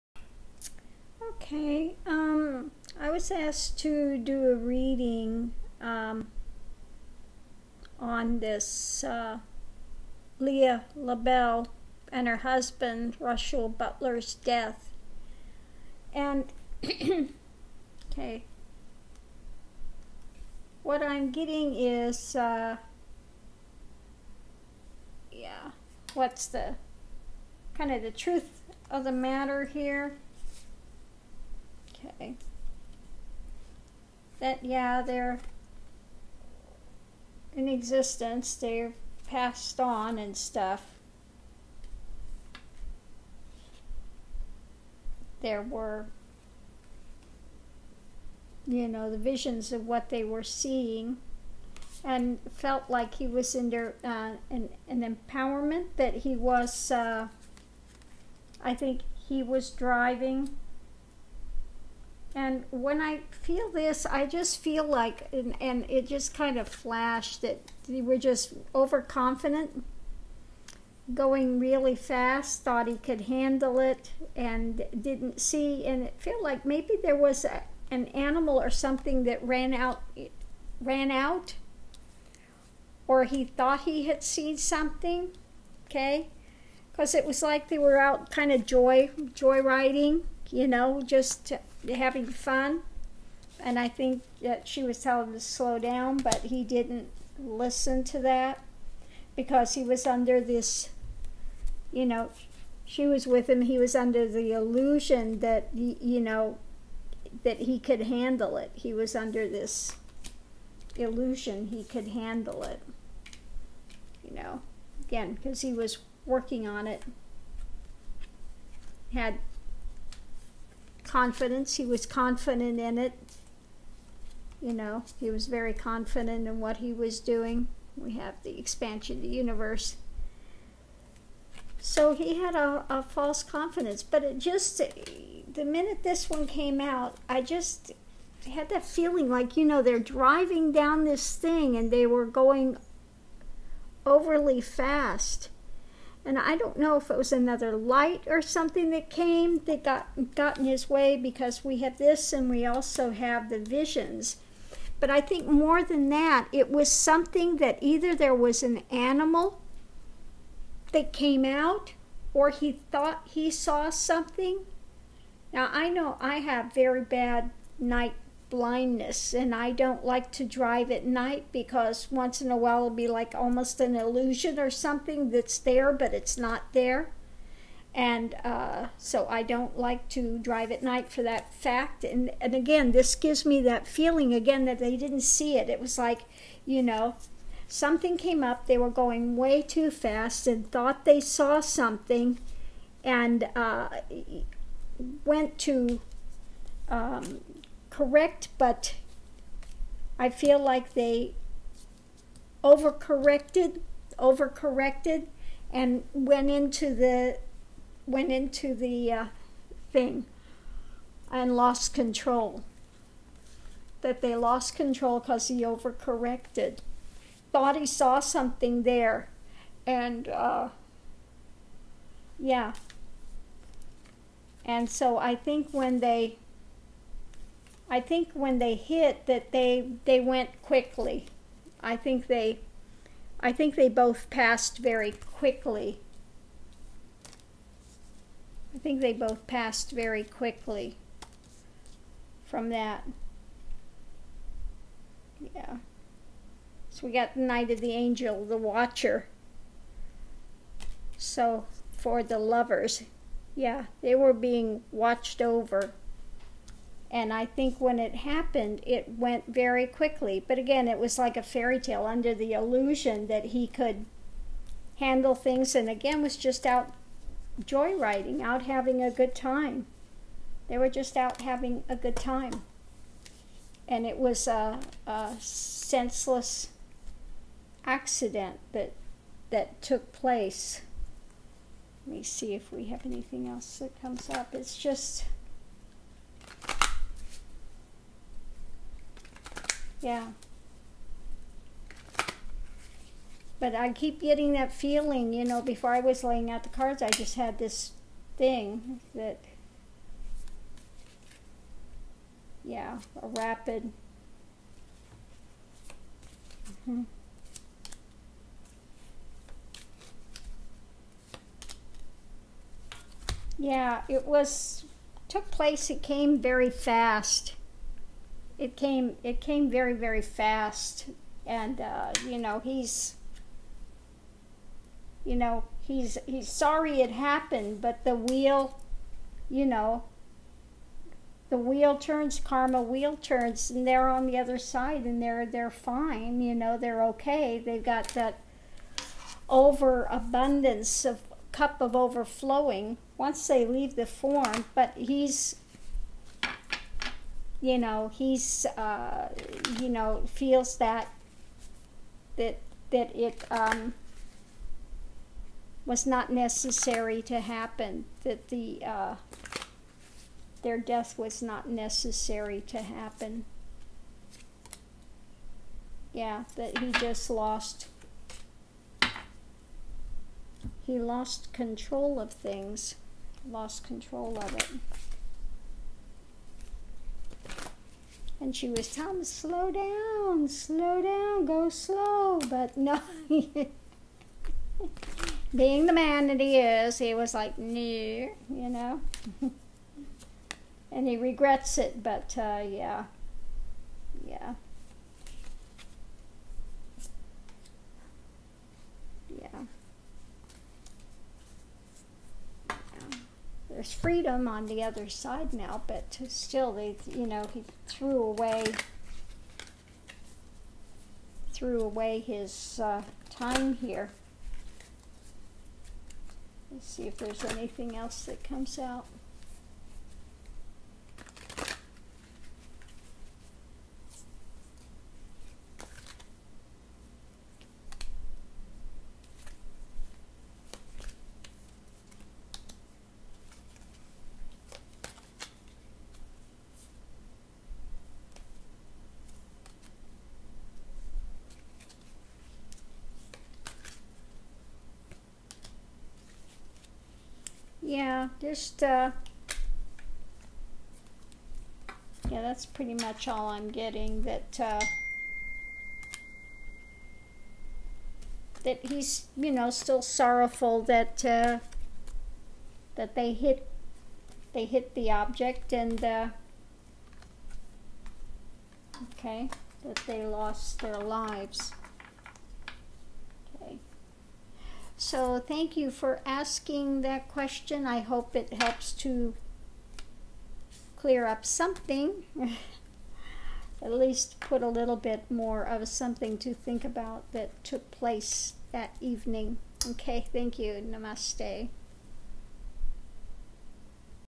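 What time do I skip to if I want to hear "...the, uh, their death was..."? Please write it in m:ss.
5:58.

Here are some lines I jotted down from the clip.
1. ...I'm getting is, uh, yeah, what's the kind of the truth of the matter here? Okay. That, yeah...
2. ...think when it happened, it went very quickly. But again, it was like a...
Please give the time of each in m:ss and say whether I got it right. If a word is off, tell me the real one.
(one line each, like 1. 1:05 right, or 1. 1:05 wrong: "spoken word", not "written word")
1. 0:21 right
2. 4:17 right.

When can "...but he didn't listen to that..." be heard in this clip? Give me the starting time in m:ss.
1:36.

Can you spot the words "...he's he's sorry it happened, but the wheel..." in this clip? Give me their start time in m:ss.
5:25.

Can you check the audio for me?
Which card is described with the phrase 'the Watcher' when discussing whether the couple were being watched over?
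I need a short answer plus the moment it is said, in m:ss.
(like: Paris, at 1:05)
Knight of the Angel, at 4:07.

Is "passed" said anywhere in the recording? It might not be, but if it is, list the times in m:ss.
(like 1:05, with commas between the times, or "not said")
0:39, 3:54, 3:59.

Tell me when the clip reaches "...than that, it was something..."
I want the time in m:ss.
2:35.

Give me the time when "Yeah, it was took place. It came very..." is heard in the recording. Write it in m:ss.
5:13.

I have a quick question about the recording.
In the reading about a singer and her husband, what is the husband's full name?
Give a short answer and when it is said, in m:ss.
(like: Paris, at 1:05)
Russell Butler, at 0:13.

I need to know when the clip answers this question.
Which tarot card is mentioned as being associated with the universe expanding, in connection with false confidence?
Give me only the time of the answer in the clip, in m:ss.
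2:08.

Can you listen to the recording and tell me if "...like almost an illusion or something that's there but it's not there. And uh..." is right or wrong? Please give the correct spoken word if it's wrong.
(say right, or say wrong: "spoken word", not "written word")
right.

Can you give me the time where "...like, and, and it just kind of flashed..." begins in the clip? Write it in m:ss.
1:04.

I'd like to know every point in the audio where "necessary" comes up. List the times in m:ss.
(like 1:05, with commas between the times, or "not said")
5:56, 6:01.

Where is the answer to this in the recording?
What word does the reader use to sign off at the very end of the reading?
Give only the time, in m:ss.
8:10.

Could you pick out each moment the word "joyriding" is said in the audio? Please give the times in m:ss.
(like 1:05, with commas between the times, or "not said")
1:29, 4:27.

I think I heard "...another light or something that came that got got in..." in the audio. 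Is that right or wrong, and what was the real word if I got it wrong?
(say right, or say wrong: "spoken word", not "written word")
right.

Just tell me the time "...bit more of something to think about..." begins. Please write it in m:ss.
8:04.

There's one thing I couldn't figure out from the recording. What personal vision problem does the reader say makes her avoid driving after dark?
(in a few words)
night blindness.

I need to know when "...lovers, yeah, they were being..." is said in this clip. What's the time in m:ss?
4:12.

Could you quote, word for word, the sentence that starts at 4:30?
They were just out having a good time.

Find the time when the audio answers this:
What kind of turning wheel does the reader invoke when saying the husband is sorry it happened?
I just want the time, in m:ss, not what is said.
5:32.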